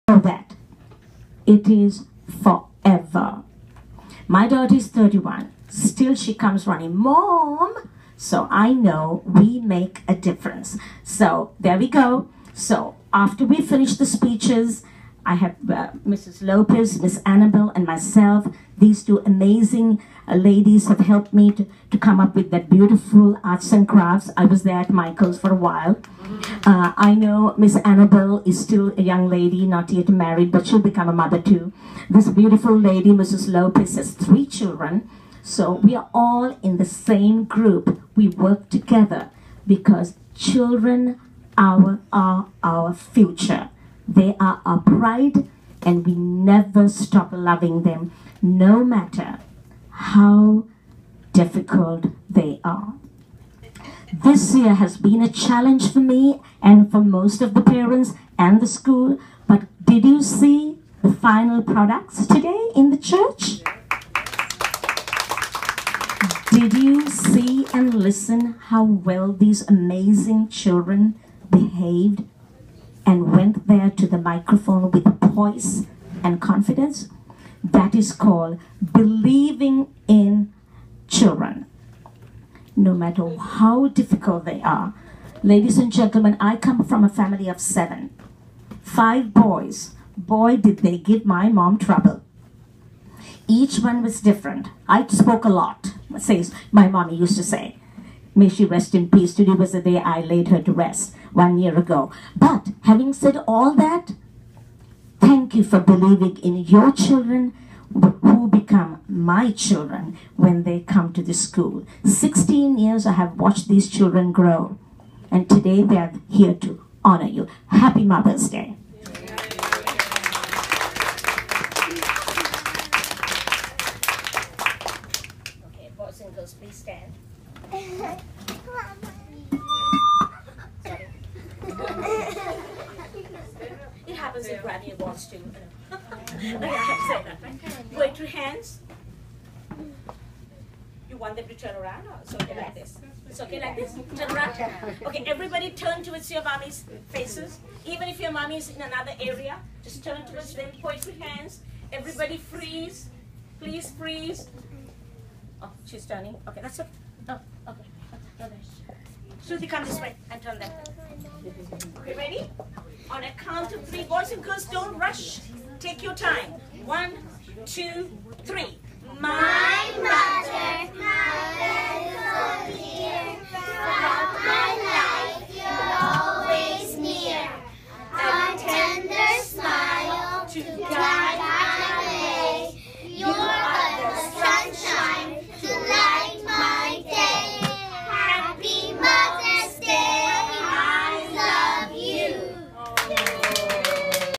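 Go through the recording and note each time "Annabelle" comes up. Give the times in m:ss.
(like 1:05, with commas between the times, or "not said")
0:17, 0:27.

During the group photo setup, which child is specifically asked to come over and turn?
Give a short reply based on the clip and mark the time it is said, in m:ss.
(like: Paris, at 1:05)
Shruti, at 2:39.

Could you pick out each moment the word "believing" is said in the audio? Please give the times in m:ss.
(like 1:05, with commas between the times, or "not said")
1:18, 1:45.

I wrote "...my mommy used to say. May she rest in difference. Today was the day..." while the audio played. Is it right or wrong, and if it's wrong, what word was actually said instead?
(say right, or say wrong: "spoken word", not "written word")
wrong: "peace", not "difference".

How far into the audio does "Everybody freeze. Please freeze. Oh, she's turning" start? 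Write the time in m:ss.
2:31.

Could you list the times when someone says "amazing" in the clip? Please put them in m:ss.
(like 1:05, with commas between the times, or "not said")
0:19, 1:09.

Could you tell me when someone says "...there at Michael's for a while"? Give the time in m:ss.
0:24.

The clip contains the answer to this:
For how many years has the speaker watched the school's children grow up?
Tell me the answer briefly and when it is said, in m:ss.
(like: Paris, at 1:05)
16, at 1:52.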